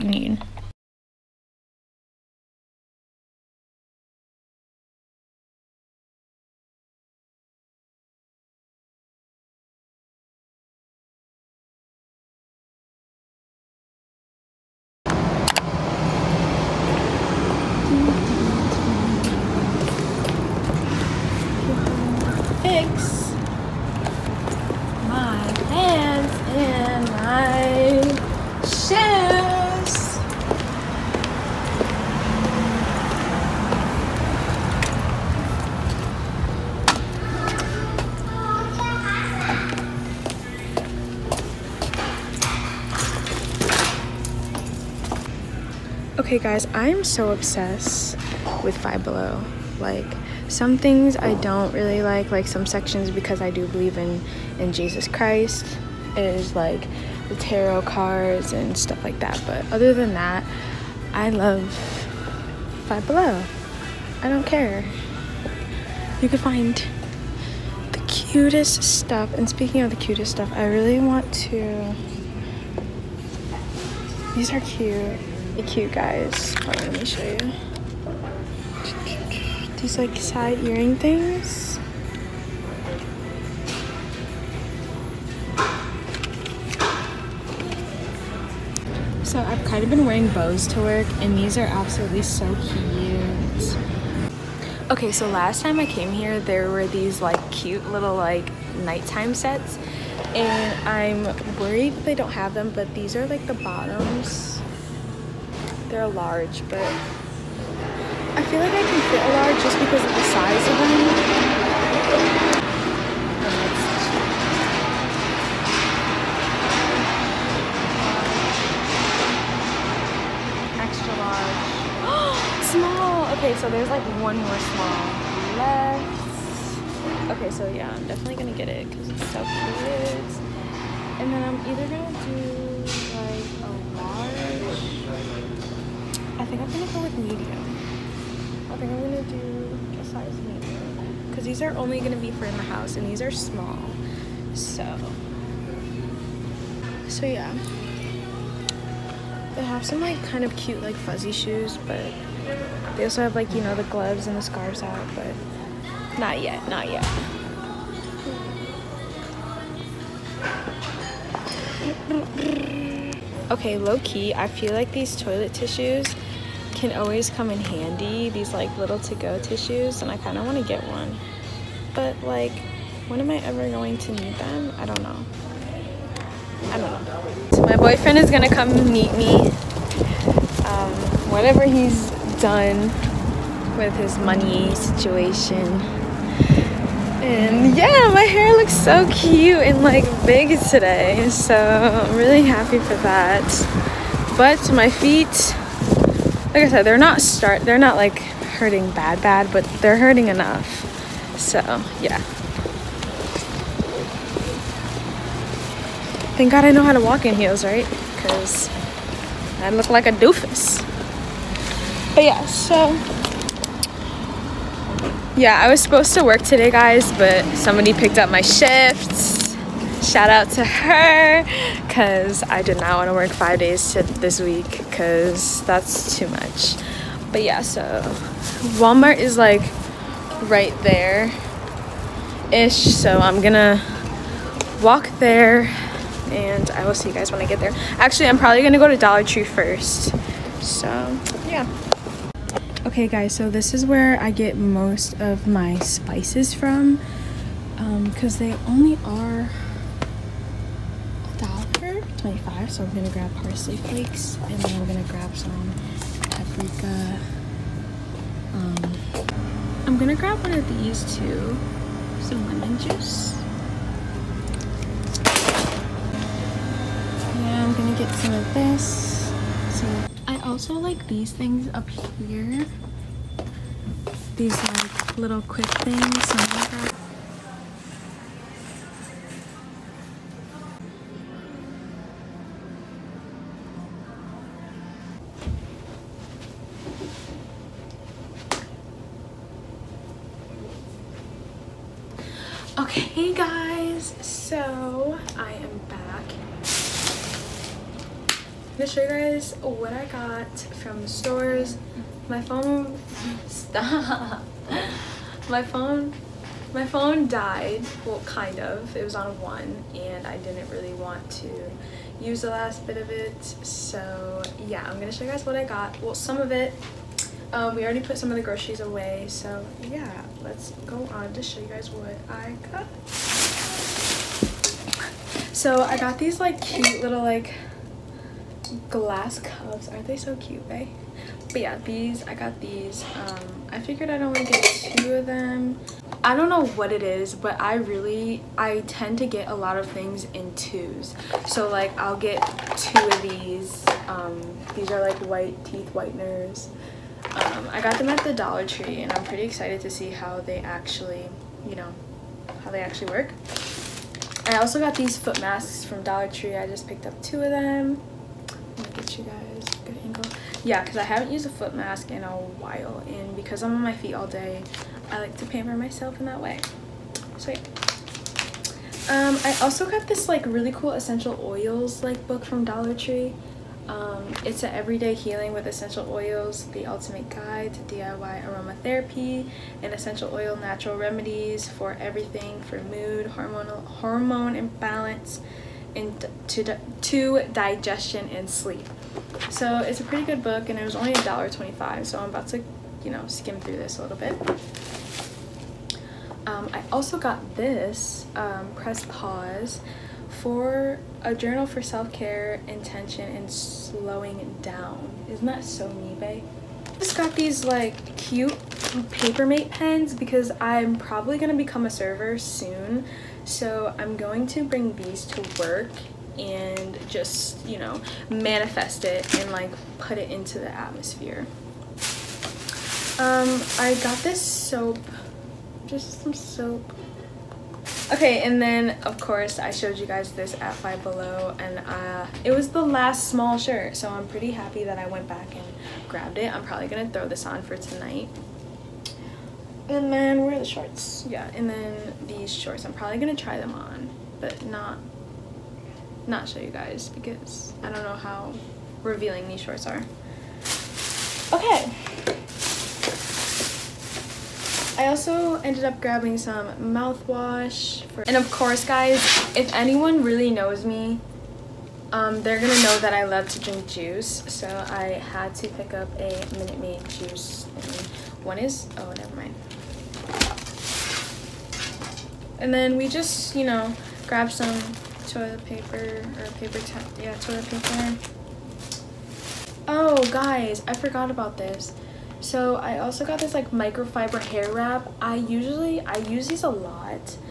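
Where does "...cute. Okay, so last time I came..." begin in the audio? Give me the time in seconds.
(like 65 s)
92 s.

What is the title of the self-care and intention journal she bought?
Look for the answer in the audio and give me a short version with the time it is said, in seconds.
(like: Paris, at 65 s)
Press Pause, at 398 s.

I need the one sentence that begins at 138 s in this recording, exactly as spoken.
I think I'm gonna do a size medium.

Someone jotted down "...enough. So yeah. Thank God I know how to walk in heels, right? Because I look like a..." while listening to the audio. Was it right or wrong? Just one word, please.
right.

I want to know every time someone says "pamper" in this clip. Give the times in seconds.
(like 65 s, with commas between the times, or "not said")
365 s.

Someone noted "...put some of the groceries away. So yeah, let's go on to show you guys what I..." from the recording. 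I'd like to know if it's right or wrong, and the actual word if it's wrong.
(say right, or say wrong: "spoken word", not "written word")
right.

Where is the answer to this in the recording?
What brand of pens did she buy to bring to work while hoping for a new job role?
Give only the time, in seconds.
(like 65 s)
409 s.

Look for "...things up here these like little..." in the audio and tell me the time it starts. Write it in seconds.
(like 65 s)
271 s.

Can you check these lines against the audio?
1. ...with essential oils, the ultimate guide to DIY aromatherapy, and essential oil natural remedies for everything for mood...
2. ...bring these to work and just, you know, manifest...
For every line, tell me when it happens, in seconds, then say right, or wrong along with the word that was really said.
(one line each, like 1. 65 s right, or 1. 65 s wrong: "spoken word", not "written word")
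1. 375 s right
2. 414 s right.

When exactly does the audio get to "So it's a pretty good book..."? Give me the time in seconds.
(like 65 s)
389 s.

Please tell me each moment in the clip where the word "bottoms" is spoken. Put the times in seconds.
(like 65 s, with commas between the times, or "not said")
103 s.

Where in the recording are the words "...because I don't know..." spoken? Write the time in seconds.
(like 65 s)
447 s.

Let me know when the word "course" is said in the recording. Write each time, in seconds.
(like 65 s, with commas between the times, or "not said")
429 s, 458 s.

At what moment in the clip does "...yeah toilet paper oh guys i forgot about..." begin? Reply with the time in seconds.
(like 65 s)
477 s.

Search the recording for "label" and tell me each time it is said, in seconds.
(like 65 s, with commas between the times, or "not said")
not said.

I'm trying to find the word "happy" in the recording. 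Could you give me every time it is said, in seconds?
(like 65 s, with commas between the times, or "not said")
192 s, 434 s.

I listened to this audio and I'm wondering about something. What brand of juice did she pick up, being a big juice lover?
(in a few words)
Minute Maid.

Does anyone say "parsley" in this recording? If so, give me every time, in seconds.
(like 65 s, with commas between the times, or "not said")
253 s.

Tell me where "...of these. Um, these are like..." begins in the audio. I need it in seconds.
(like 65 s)
343 s.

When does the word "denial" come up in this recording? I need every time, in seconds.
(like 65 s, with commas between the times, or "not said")
not said.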